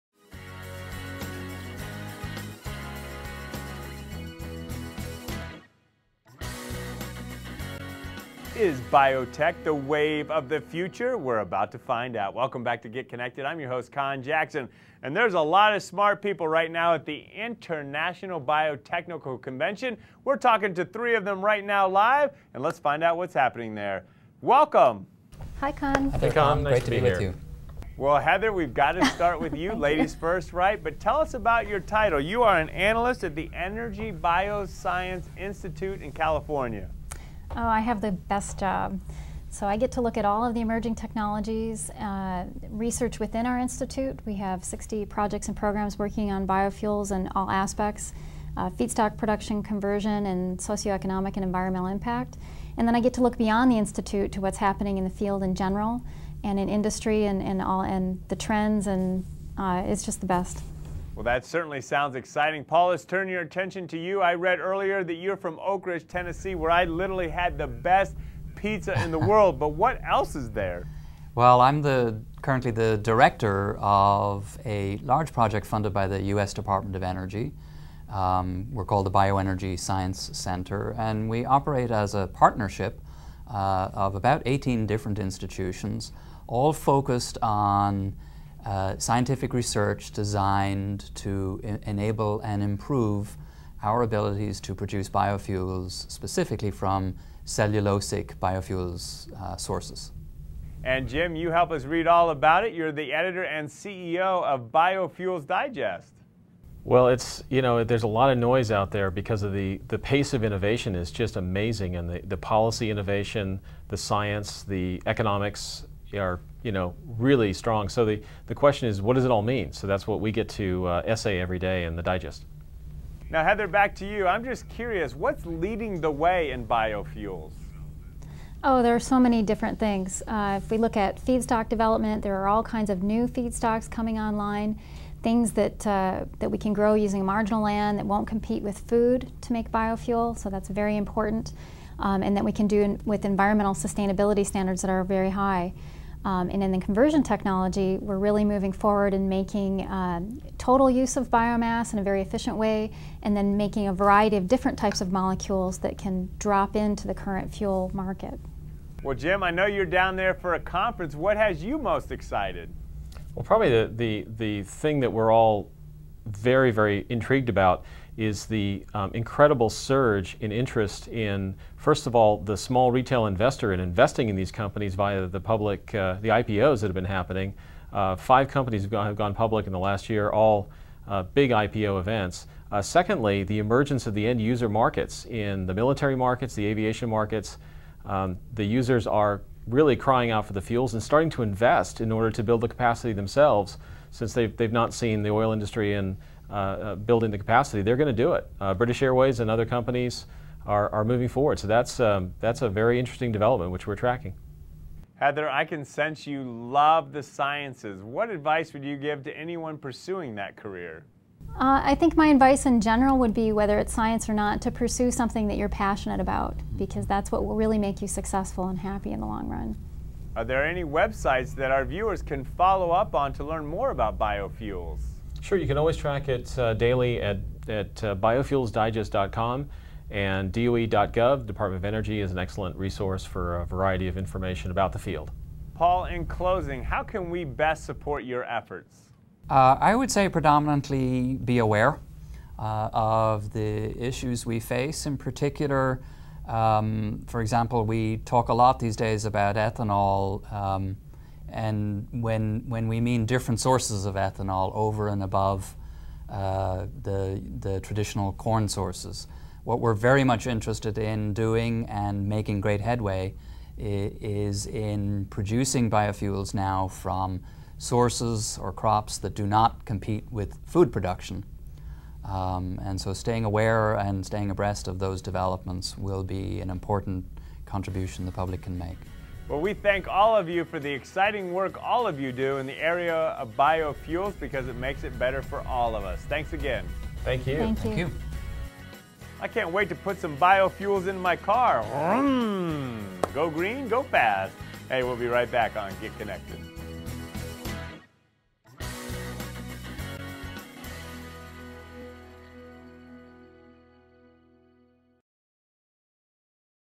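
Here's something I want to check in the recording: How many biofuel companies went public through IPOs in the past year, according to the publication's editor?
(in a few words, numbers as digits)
5.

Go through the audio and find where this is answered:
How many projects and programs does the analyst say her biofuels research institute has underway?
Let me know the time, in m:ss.
0:44.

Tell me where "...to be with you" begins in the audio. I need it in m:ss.
0:26.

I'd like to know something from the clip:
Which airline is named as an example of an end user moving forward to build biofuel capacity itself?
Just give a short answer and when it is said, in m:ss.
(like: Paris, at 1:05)
British Airways, at 3:18.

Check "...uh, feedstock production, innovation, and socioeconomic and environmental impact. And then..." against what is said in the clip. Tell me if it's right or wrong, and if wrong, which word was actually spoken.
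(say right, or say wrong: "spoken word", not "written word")
wrong: "conversion", not "innovation".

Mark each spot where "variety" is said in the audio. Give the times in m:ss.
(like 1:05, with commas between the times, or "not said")
2:33, 3:53.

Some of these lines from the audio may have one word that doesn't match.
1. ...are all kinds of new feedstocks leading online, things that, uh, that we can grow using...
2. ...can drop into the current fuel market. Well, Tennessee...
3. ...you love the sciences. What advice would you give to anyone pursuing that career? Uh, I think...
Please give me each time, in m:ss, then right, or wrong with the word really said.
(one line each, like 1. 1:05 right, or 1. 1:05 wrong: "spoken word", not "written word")
1. 2:12 wrong: "coming", not "leading"
2. 2:35 wrong: "Jim", not "Tennessee"
3. 3:26 right.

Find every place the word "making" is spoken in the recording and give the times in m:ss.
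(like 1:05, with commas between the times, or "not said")
2:29, 2:33, 4:22.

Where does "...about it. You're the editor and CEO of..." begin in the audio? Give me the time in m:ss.
1:42.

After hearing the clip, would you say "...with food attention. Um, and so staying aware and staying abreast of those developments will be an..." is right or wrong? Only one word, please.
wrong.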